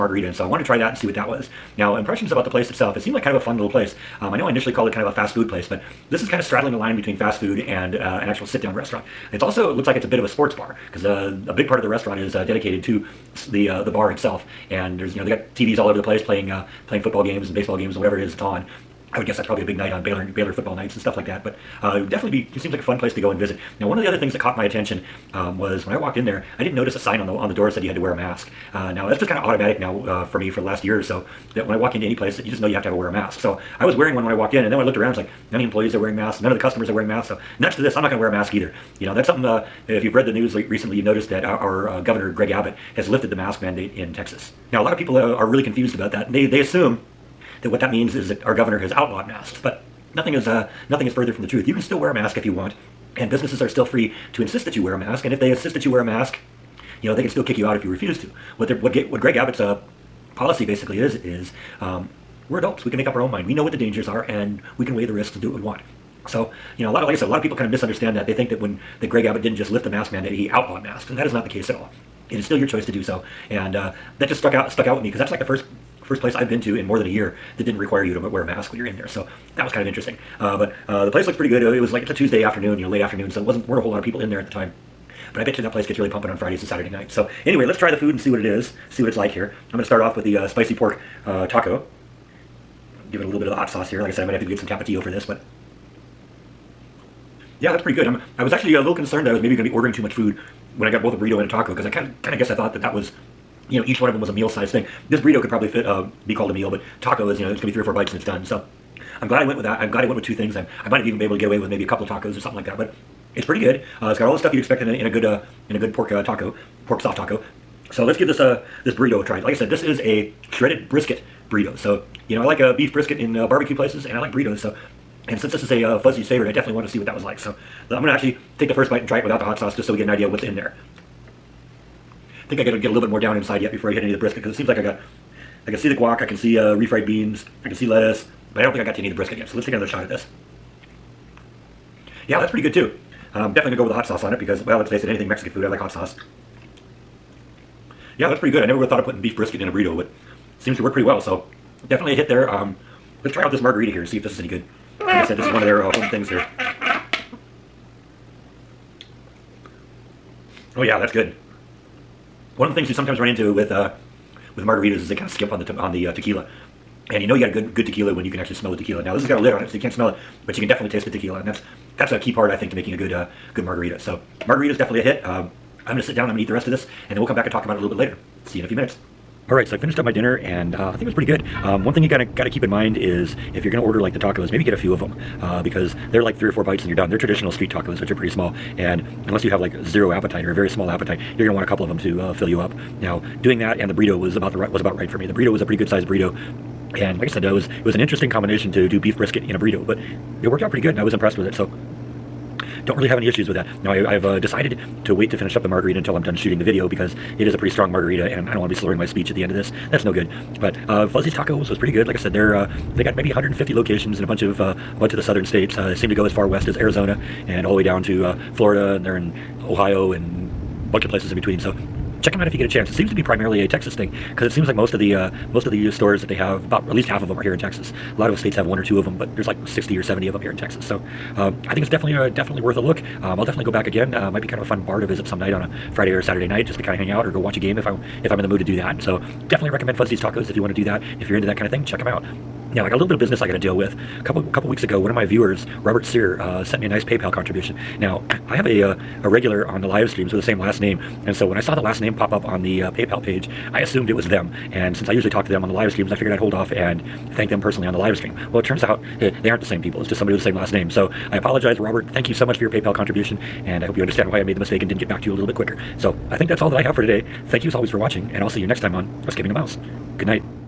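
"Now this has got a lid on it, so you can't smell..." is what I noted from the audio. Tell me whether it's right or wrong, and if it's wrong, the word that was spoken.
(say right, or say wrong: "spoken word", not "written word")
right.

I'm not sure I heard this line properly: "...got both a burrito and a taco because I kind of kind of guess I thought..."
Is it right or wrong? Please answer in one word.
right.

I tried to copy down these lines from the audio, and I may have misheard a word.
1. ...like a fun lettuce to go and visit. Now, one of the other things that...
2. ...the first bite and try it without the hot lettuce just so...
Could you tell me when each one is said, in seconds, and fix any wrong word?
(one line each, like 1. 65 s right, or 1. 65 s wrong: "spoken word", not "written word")
1. 22 s wrong: "place", not "lettuce"
2. 128 s wrong: "sauce", not "lettuce".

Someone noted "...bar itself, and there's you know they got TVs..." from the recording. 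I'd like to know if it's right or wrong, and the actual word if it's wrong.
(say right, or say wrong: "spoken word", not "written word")
right.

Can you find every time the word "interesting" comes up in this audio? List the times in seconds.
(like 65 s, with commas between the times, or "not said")
79 s, 197 s.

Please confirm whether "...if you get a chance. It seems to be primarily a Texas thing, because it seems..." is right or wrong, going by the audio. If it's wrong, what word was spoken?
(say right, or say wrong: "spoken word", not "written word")
right.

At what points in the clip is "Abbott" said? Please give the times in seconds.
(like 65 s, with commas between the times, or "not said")
42 s, 59 s, 69 s.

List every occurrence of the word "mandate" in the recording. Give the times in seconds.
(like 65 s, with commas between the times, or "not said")
43 s, 70 s.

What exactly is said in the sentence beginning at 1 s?
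Now impressions about the place itself.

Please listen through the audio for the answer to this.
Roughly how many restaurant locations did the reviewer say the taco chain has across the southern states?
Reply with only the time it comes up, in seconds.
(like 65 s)
213 s.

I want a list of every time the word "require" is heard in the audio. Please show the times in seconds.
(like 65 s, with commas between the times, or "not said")
77 s.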